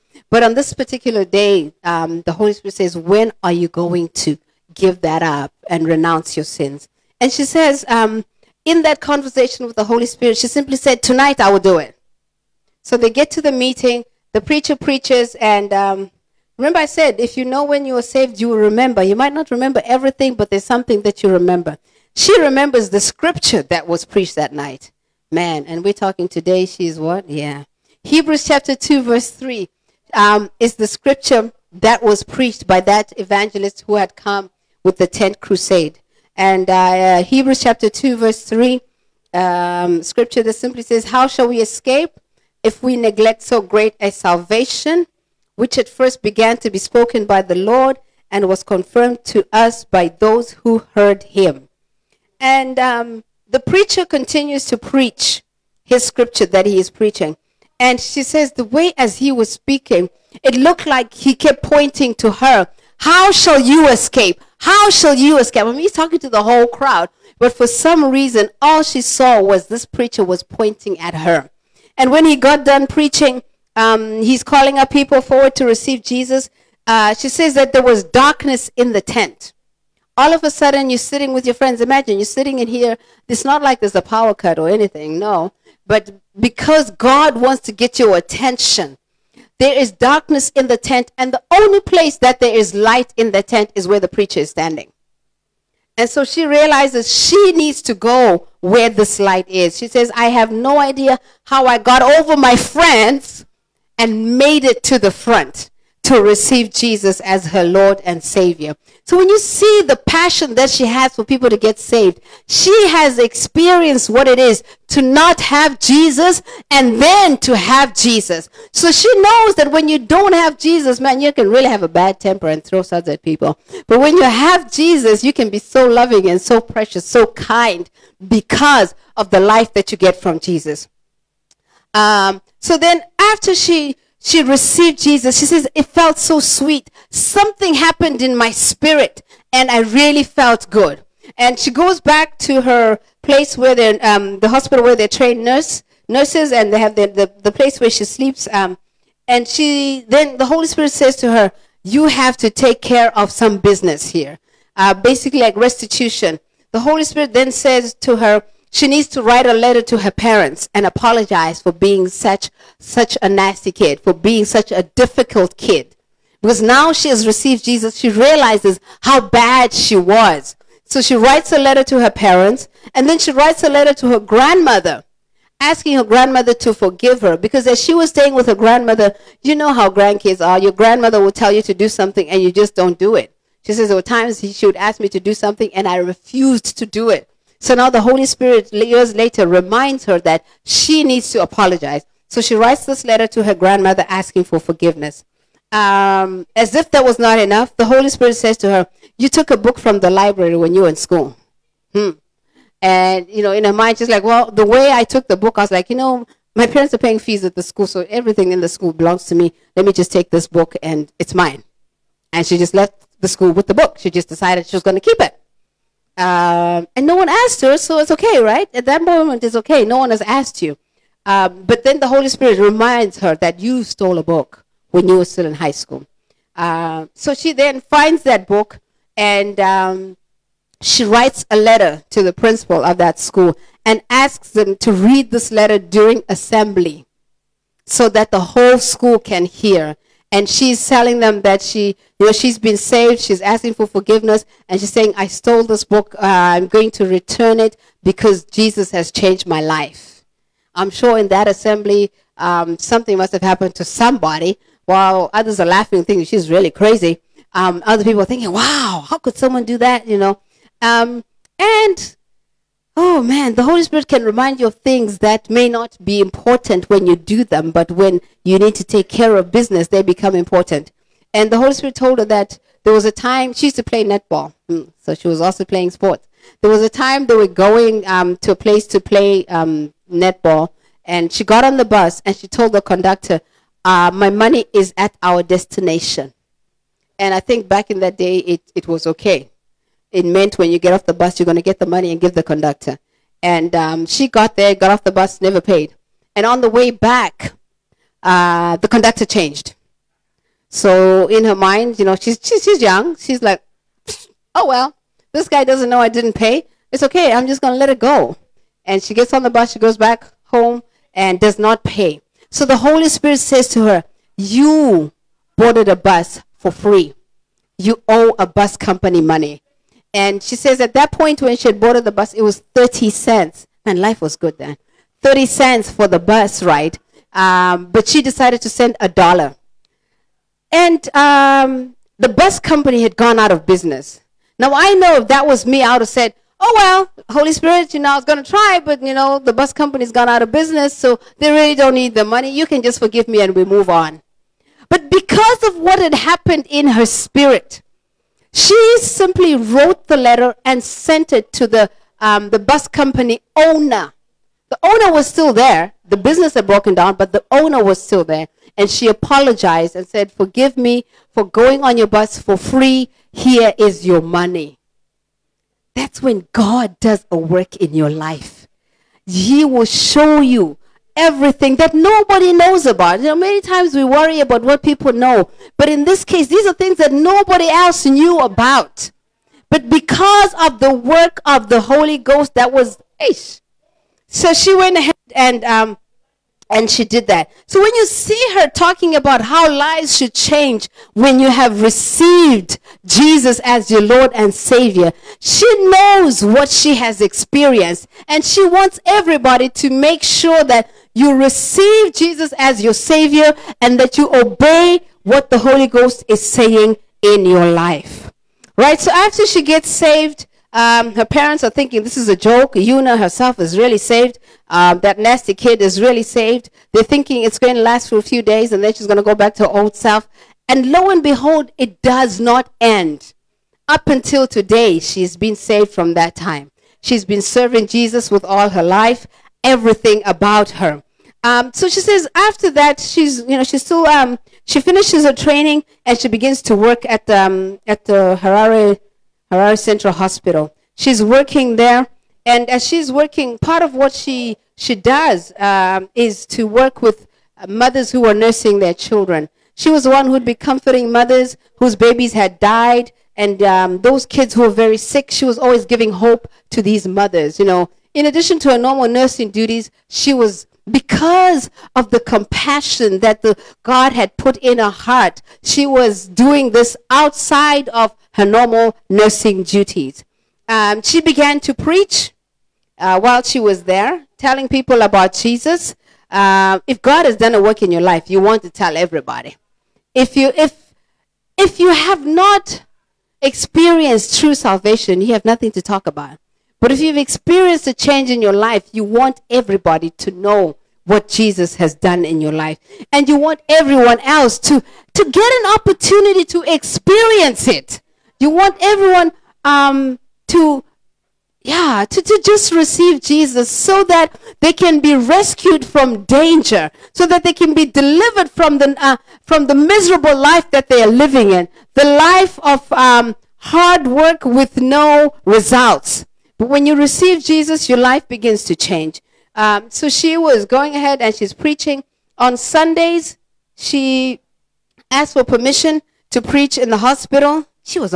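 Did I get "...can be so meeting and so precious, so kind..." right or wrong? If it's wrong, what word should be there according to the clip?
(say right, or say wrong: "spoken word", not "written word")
wrong: "loving", not "meeting".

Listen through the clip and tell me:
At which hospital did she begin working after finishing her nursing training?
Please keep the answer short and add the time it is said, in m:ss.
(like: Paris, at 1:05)
Harare Central Hospital, at 7:19.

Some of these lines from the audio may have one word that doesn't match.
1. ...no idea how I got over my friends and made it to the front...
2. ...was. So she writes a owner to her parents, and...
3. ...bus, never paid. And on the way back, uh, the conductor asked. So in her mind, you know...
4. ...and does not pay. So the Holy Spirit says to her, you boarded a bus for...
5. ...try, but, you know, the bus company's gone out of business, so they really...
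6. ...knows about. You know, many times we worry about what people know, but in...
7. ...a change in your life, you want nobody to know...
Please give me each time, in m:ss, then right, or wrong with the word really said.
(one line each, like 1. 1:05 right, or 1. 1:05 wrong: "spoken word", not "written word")
1. 1:40 right
2. 2:49 wrong: "letter", not "owner"
3. 4:55 wrong: "changed", not "asked"
4. 5:11 right
5. 5:38 right
6. 6:12 right
7. 8:07 wrong: "everybody", not "nobody".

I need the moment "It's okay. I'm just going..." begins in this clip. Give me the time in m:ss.
5:06.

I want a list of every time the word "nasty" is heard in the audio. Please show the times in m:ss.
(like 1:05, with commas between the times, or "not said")
2:43, 6:55.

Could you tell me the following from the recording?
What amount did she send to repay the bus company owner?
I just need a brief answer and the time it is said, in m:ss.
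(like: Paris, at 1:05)
A dollar, at 5:28.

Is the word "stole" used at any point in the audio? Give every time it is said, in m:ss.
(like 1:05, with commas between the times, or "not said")
3:43, 4:05.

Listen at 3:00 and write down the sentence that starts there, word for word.
Your grandmother will tell you to do something, and you just don't do it.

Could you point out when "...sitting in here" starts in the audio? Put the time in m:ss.
1:22.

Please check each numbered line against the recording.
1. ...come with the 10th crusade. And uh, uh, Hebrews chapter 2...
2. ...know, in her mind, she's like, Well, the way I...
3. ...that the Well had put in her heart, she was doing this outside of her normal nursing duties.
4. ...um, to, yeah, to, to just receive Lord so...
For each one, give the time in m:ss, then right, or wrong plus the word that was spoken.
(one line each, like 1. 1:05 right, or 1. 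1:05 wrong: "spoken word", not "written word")
1. 0:34 right
2. 3:23 right
3. 7:43 wrong: "God", not "Well"
4. 8:19 wrong: "Jesus", not "Lord".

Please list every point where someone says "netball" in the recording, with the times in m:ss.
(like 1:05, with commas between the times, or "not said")
4:34, 4:40.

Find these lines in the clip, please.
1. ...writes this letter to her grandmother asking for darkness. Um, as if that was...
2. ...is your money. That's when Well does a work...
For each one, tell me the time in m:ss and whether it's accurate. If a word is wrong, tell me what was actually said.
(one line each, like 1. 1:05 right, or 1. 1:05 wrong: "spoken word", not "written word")
1. 3:12 wrong: "forgiveness", not "darkness"
2. 6:03 wrong: "God", not "Well".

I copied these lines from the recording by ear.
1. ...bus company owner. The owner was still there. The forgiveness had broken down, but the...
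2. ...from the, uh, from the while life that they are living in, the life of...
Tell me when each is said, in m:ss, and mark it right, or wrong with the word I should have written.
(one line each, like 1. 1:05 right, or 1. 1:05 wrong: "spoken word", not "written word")
1. 5:52 wrong: "business", not "forgiveness"
2. 8:28 wrong: "miserable", not "while".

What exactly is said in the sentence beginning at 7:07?
She's been serving Jesus with all her life everything about her.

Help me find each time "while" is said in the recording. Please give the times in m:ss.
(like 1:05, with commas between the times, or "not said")
4:14, 7:53.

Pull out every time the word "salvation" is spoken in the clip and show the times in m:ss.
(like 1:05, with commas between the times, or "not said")
0:44, 8:04.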